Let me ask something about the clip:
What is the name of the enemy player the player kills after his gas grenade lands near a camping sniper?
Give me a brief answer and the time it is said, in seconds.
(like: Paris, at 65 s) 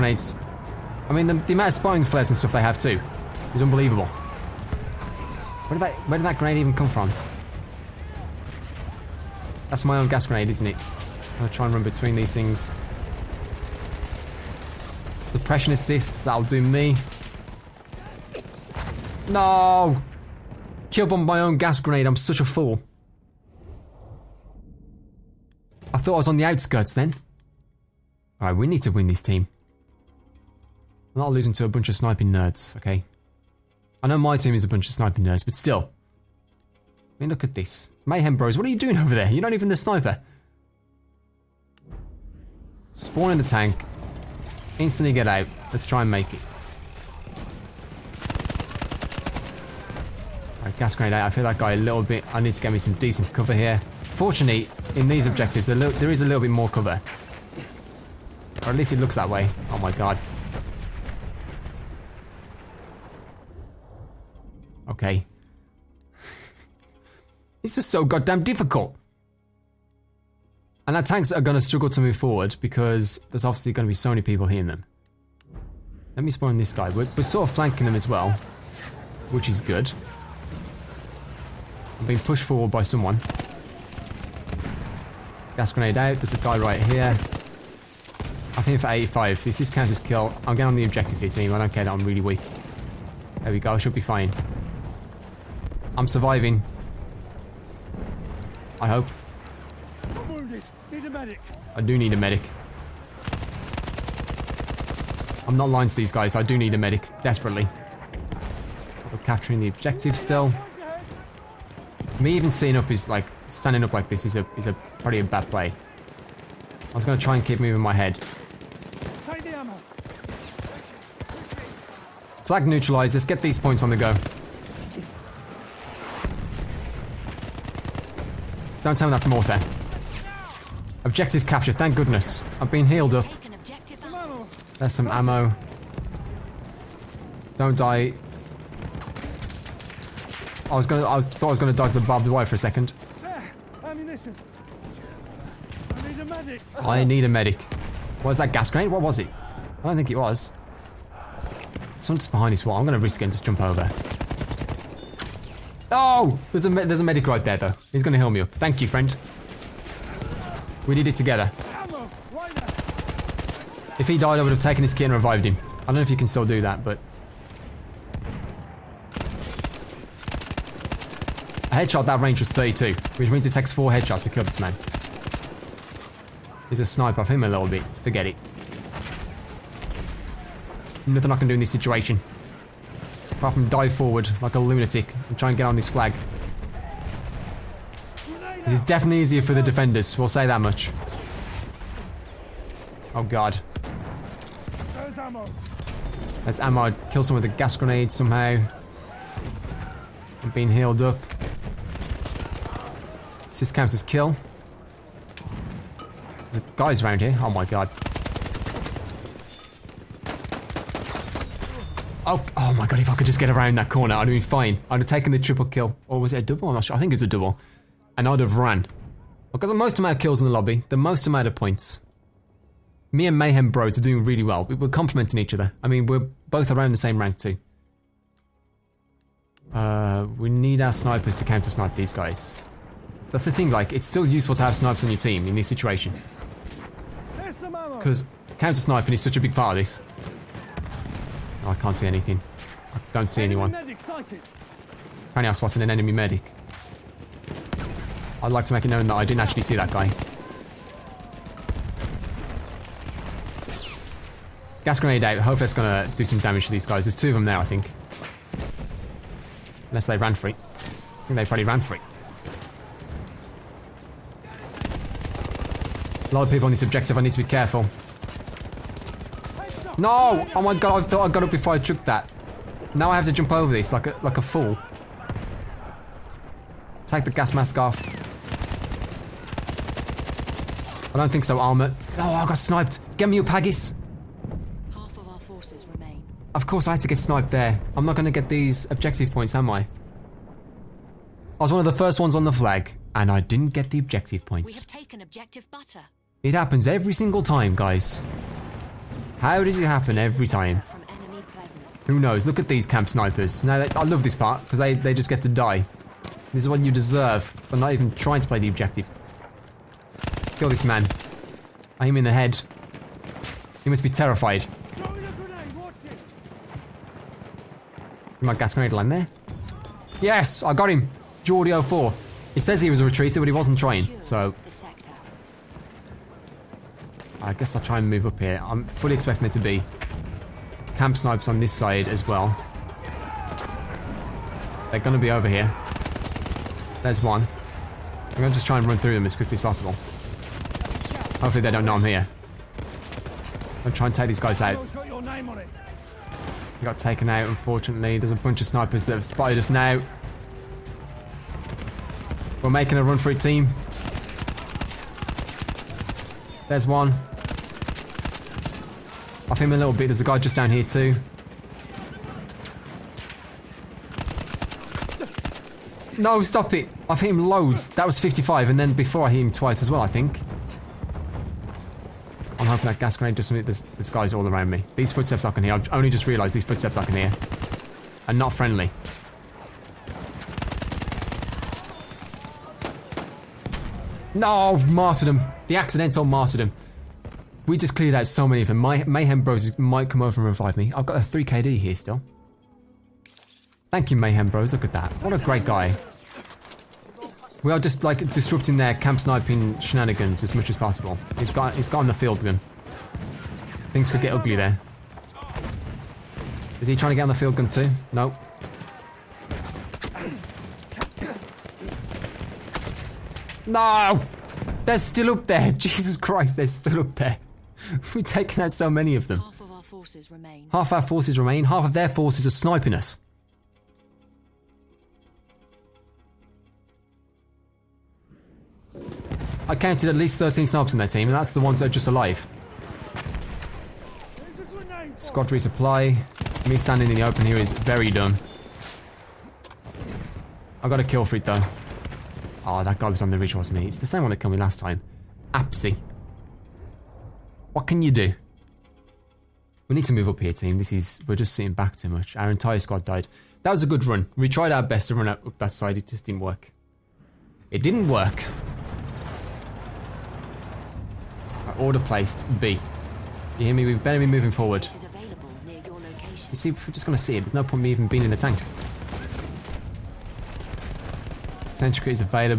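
Geordie 04, at 321 s.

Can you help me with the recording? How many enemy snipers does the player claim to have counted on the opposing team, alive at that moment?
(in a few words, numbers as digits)
13.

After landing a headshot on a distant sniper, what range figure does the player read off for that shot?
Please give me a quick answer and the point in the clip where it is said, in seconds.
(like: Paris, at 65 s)
32, at 172 s.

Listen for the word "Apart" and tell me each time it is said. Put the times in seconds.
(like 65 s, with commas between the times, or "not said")
183 s.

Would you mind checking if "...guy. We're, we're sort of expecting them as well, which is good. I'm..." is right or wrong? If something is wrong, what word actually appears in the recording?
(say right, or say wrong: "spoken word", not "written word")
wrong: "flanking", not "expecting".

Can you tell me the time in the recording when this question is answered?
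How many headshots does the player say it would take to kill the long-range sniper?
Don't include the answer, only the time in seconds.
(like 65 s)
173 s.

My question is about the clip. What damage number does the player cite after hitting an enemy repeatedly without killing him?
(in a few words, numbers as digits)
55.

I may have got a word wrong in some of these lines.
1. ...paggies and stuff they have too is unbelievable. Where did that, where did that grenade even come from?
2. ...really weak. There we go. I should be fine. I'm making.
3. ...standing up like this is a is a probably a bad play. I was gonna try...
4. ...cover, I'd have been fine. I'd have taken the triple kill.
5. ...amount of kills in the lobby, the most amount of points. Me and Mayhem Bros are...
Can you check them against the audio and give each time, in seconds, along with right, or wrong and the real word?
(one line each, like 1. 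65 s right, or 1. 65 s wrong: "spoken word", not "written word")
1. 2 s wrong: "flares", not "paggies"
2. 92 s wrong: "surviving", not "making"
3. 113 s right
4. 213 s wrong: "corner", not "cover"
5. 219 s right.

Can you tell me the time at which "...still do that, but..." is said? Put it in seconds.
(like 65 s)
166 s.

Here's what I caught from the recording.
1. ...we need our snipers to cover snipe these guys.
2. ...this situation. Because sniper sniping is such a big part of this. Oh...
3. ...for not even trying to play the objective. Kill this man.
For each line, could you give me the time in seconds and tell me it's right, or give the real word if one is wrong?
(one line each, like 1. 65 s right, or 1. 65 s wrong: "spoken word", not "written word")
1. 230 s wrong: "counter", not "cover"
2. 235 s wrong: "counter", not "sniper"
3. 307 s right.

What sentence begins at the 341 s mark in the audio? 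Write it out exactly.
Hopefully they don't know I'm here.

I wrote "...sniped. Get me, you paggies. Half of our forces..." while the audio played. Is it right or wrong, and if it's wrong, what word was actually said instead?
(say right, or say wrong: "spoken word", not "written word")
right.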